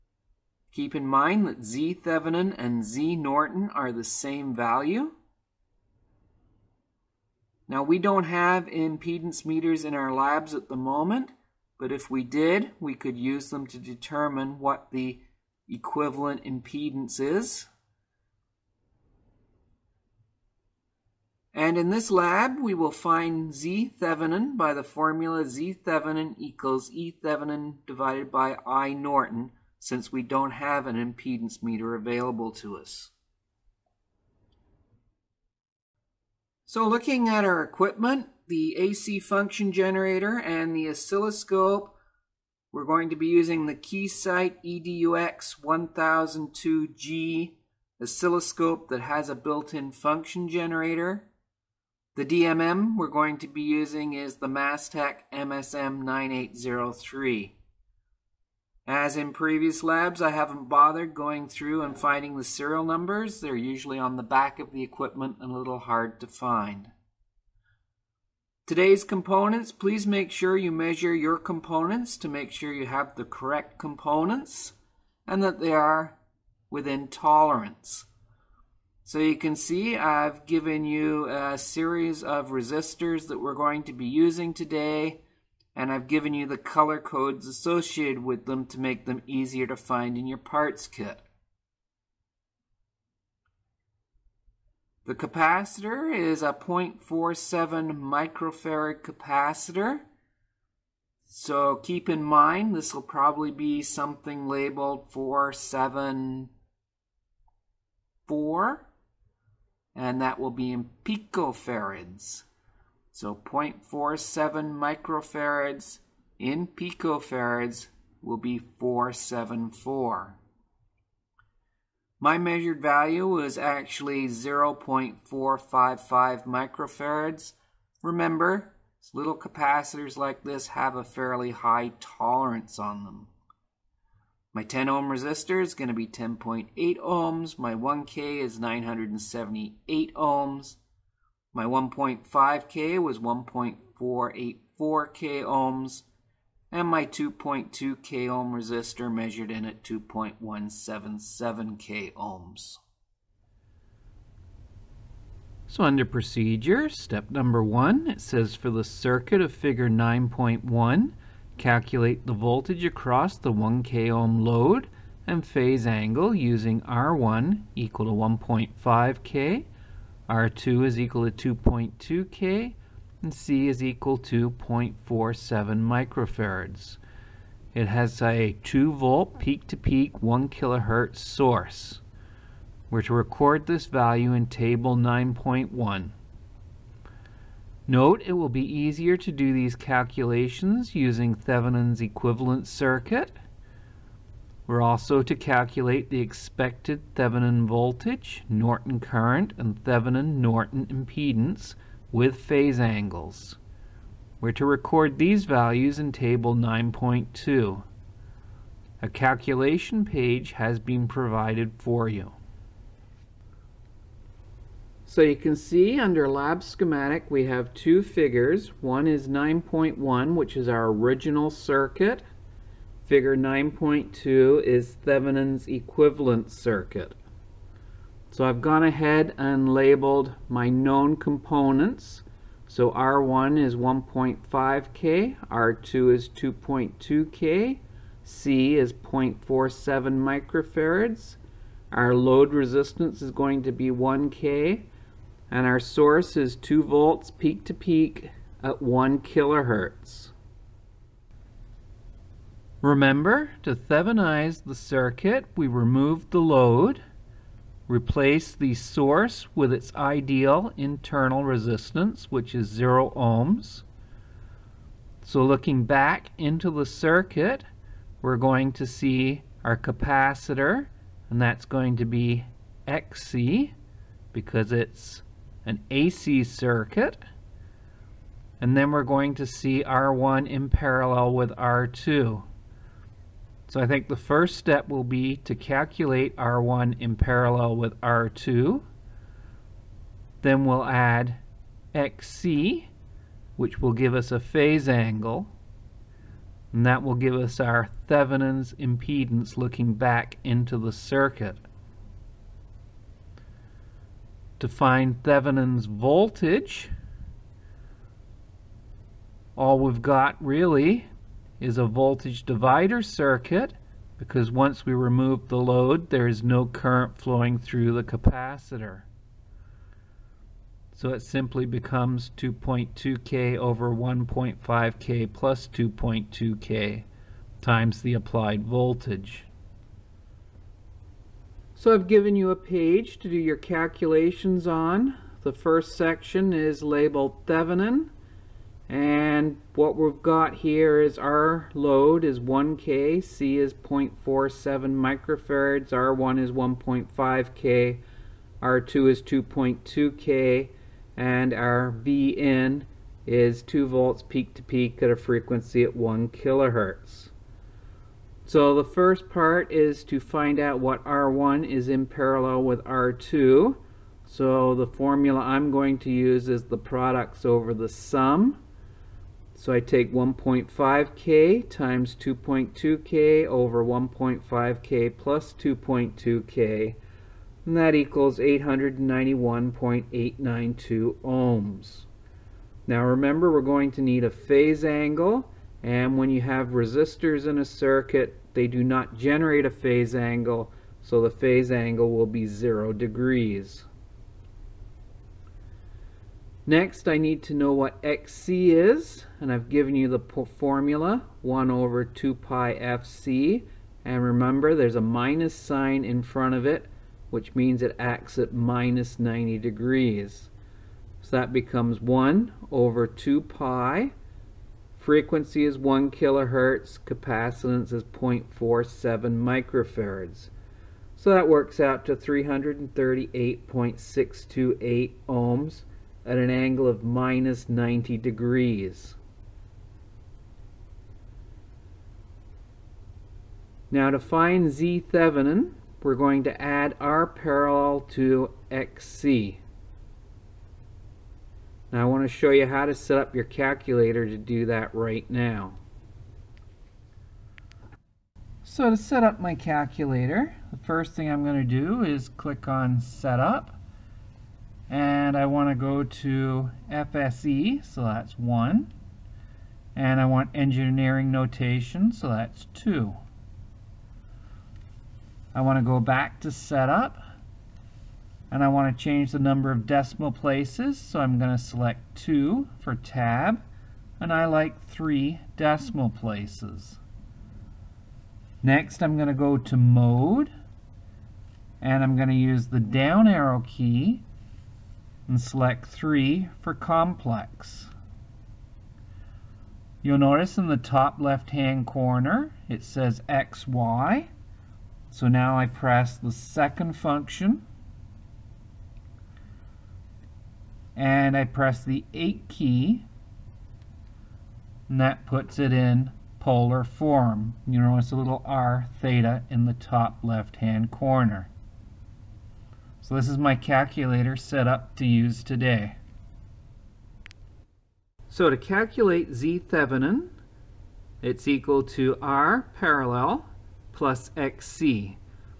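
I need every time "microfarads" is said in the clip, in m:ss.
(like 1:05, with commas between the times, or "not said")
1:37, 1:54, 2:06, 2:55, 4:00, 5:44, 6:59.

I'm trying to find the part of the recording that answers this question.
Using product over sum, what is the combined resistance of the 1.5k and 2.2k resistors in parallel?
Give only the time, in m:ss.
6:18.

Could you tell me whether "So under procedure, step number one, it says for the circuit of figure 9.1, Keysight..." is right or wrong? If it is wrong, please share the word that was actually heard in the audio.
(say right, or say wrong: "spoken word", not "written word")
wrong: "Calculate", not "Keysight".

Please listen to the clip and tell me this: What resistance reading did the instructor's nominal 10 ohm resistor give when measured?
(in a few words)
10.8 ohms.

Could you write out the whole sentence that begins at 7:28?
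So to set up my calculator, the first thing I'm going to do is click on Setup.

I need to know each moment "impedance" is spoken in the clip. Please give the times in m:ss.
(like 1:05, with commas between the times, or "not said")
0:08, 0:16, 0:30, 3:20, 4:58.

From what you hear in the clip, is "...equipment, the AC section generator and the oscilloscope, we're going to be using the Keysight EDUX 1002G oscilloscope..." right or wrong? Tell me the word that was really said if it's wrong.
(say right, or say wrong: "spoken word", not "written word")
wrong: "function", not "section".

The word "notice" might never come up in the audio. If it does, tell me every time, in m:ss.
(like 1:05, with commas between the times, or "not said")
8:10, 8:27.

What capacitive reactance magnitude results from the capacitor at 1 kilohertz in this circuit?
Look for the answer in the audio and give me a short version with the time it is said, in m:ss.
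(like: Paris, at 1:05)
338.628 ohms, at 7:02.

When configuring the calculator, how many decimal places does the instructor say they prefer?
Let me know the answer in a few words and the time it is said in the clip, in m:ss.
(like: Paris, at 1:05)
3, at 7:54.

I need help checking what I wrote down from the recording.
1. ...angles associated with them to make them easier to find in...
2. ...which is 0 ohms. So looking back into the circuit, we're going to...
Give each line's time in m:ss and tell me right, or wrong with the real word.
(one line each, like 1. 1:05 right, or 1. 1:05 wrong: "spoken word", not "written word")
1. 1:26 wrong: "codes", not "angles"
2. 4:22 right.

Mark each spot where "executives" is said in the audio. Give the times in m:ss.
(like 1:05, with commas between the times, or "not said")
not said.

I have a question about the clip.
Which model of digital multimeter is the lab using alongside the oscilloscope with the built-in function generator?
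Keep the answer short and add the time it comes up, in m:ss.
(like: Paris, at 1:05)
Mastech MSM9803, at 0:54.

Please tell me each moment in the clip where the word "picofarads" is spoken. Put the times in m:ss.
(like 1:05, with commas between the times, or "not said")
1:51, 1:56.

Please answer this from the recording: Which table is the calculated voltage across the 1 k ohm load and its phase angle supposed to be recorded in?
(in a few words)
Table 9.1.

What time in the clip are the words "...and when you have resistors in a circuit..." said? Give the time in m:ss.
6:25.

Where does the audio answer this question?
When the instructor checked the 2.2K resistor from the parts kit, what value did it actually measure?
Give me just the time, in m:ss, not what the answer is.
2:29.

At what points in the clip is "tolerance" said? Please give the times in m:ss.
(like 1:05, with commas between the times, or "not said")
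1:17, 2:11.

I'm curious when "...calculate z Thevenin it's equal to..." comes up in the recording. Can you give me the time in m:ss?
8:38.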